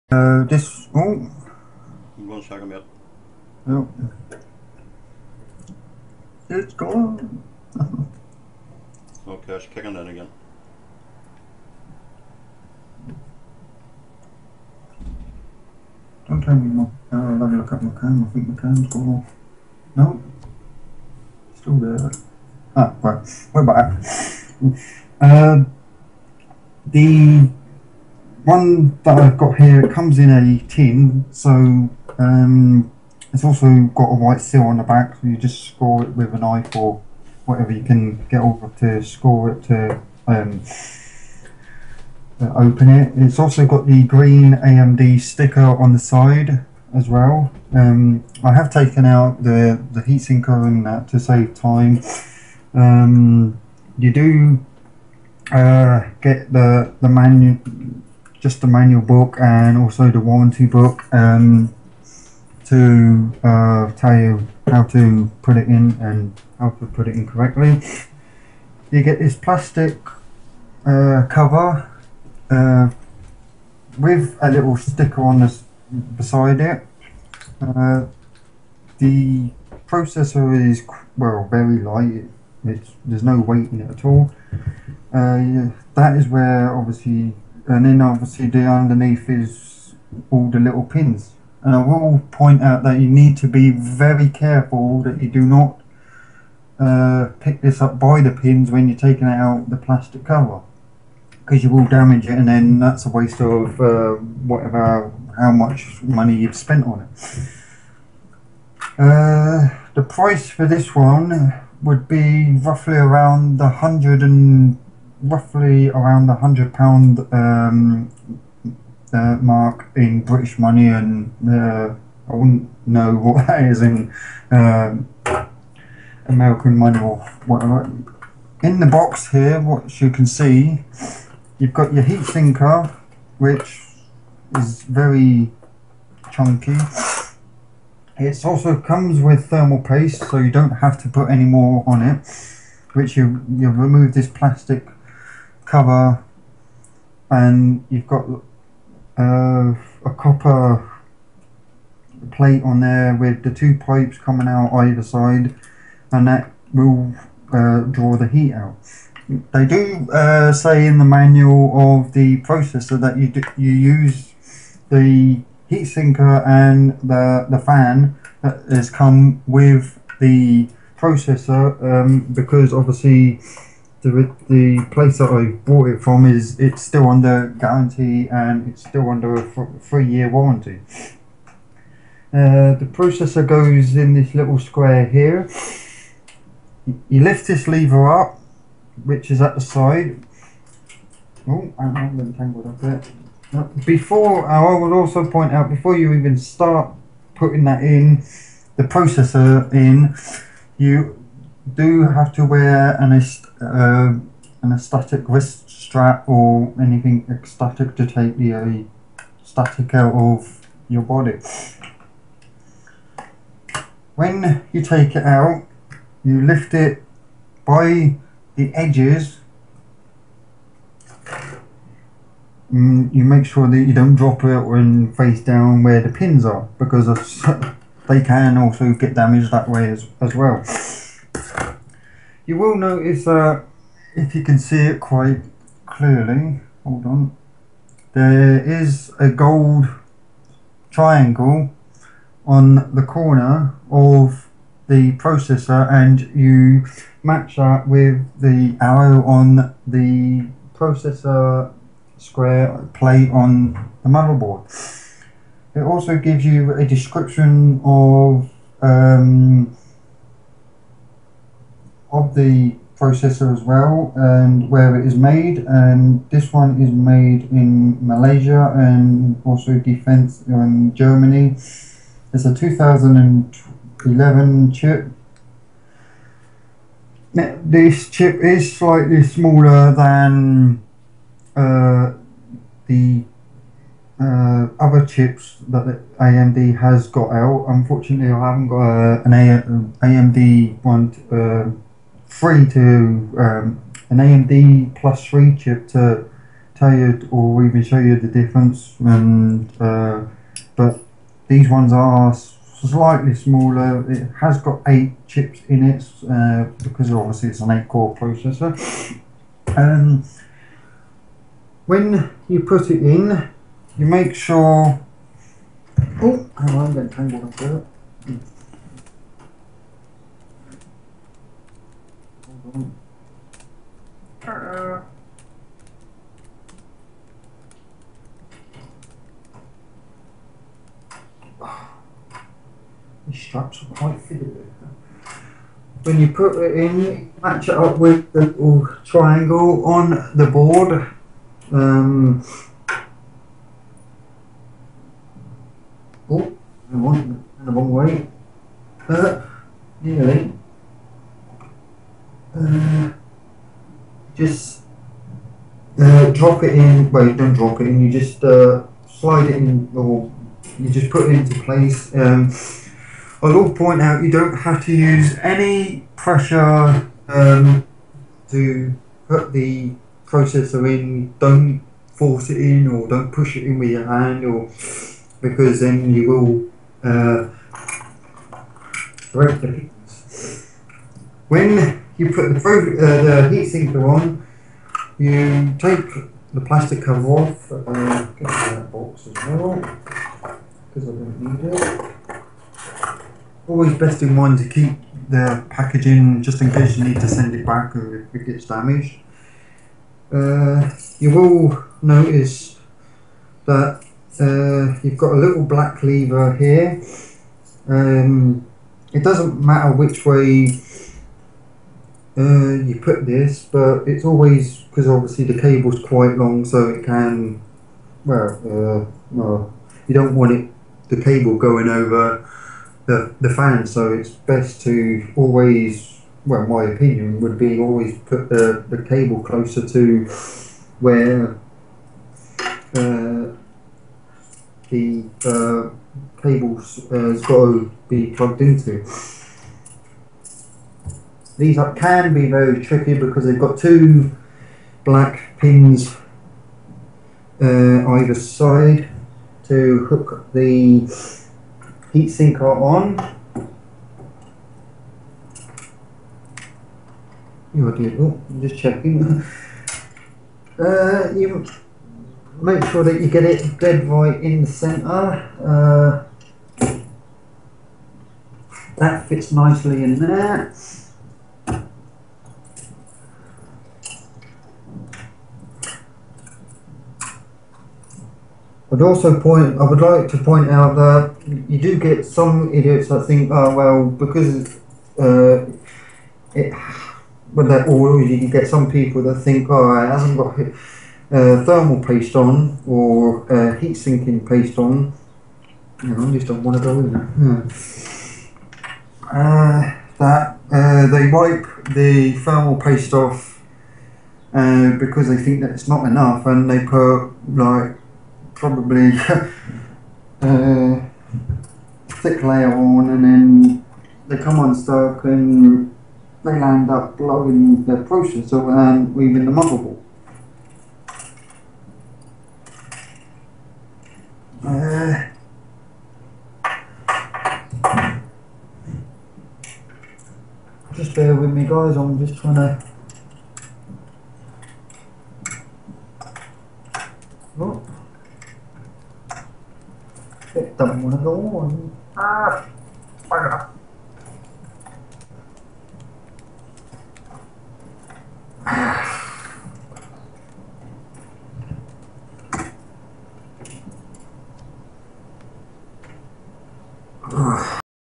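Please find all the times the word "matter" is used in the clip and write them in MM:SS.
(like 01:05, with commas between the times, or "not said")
06:49.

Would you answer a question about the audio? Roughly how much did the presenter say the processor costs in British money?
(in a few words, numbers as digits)
£100.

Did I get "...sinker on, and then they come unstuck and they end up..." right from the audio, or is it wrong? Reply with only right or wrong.
wrong.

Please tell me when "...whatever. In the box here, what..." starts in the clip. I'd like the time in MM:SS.
02:07.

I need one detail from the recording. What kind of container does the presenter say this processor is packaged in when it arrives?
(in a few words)
A tin.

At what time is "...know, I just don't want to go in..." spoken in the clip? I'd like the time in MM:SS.
08:16.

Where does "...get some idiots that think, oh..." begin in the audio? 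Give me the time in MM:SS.
08:01.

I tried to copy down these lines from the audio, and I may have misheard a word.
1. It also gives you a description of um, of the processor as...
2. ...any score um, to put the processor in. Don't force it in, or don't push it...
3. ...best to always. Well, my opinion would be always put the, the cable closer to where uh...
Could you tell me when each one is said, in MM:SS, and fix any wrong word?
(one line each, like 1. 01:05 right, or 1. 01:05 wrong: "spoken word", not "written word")
1. 04:15 right
2. 06:05 wrong: "pressure", not "score"
3. 07:04 right.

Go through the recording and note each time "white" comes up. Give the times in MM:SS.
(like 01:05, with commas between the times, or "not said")
00:34.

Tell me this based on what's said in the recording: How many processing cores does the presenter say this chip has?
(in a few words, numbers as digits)
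8.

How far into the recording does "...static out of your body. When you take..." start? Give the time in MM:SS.
03:29.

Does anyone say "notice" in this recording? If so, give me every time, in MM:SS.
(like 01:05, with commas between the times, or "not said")
03:52, 06:42.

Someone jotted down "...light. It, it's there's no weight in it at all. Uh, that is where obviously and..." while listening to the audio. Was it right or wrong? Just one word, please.
right.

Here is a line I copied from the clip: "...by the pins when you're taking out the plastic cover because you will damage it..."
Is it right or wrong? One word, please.
right.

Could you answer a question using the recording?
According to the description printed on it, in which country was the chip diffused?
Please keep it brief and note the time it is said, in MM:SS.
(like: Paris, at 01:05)
Germany, at 04:30.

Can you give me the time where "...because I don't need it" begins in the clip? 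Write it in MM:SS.
06:29.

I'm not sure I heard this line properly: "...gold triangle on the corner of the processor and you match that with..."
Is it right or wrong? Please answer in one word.
right.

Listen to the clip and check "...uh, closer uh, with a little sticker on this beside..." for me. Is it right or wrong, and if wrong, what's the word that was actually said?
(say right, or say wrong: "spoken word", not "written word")
wrong: "cover", not "closer".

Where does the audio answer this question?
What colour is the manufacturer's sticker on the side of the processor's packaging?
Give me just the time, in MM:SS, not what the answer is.
00:44.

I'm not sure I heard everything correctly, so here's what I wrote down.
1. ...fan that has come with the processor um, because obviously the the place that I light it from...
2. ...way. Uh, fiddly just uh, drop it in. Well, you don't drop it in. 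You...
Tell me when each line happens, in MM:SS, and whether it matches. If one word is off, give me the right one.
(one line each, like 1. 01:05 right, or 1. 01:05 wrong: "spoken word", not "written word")
1. 02:47 wrong: "bought", not "light"
2. 05:47 wrong: "nearly", not "fiddly".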